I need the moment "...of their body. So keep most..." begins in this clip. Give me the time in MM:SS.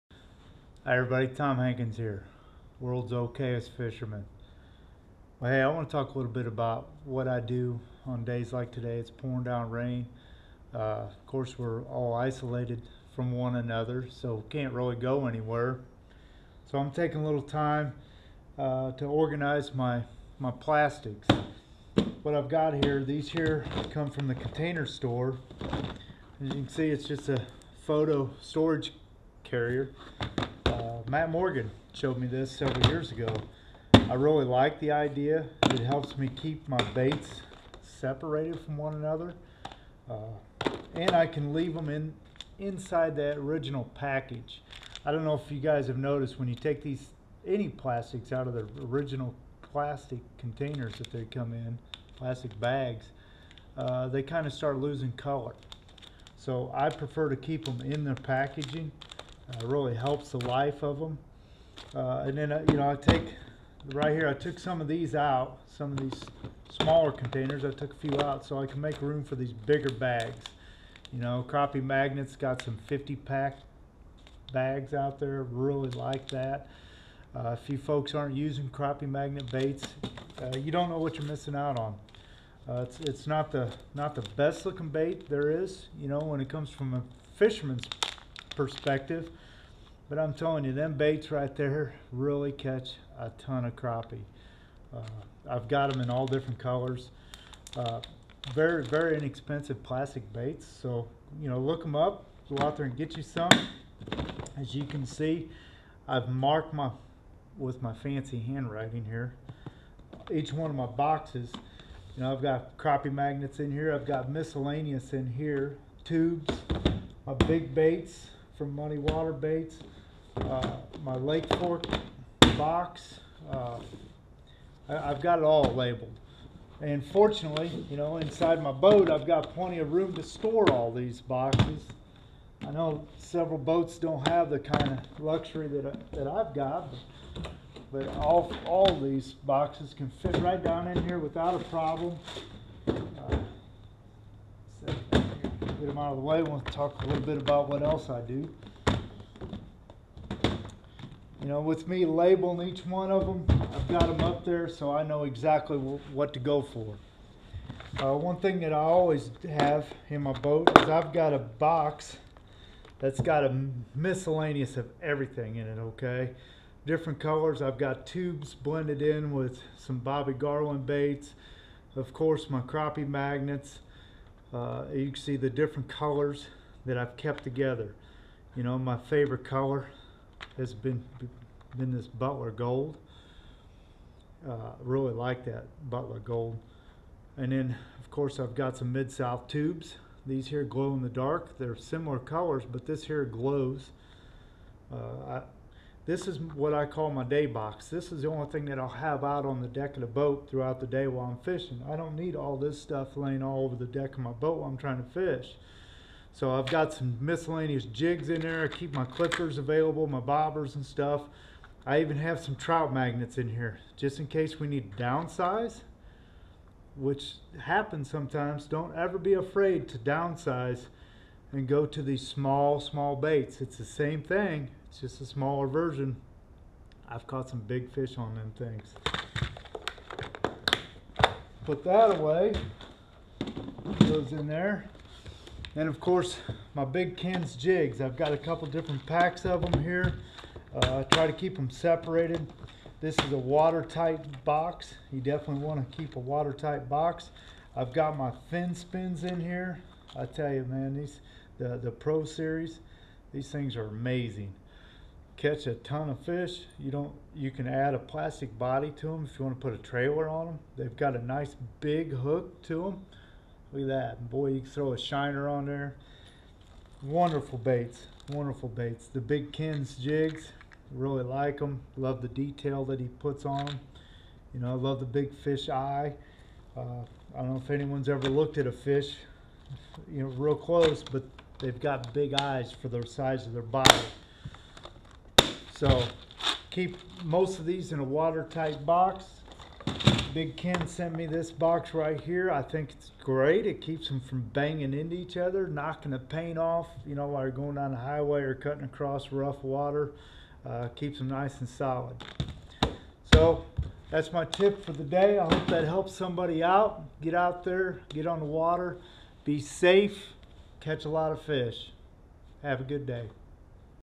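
04:43.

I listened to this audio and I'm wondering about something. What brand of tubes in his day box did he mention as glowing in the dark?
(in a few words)
Mid-South.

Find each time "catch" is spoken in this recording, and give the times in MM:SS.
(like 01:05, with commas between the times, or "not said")
01:32, 04:15, 05:10.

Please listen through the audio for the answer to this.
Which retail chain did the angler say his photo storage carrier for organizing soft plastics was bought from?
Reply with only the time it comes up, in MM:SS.
00:24.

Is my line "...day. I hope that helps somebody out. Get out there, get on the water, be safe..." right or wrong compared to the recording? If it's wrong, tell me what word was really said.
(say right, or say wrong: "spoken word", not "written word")
right.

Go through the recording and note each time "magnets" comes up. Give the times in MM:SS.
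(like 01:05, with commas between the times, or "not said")
01:11, 01:19, 01:53, 02:53, 03:32.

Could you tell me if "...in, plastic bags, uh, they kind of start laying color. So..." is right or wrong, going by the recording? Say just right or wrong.
wrong.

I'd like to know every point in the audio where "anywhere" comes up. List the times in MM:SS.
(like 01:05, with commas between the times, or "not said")
00:15.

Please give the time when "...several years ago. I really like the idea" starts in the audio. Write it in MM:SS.
00:32.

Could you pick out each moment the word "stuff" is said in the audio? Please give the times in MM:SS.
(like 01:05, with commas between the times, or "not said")
03:22, 03:30.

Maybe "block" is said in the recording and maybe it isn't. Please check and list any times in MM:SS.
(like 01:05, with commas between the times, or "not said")
not said.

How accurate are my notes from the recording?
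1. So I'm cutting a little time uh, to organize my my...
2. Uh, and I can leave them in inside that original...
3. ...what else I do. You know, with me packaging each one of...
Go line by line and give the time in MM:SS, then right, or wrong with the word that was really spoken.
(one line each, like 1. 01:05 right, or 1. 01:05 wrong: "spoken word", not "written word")
1. 00:16 wrong: "taking", not "cutting"
2. 00:40 right
3. 02:27 wrong: "labeling", not "packaging".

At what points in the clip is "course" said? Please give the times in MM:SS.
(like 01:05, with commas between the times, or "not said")
00:11, 02:52, 03:08, 03:56.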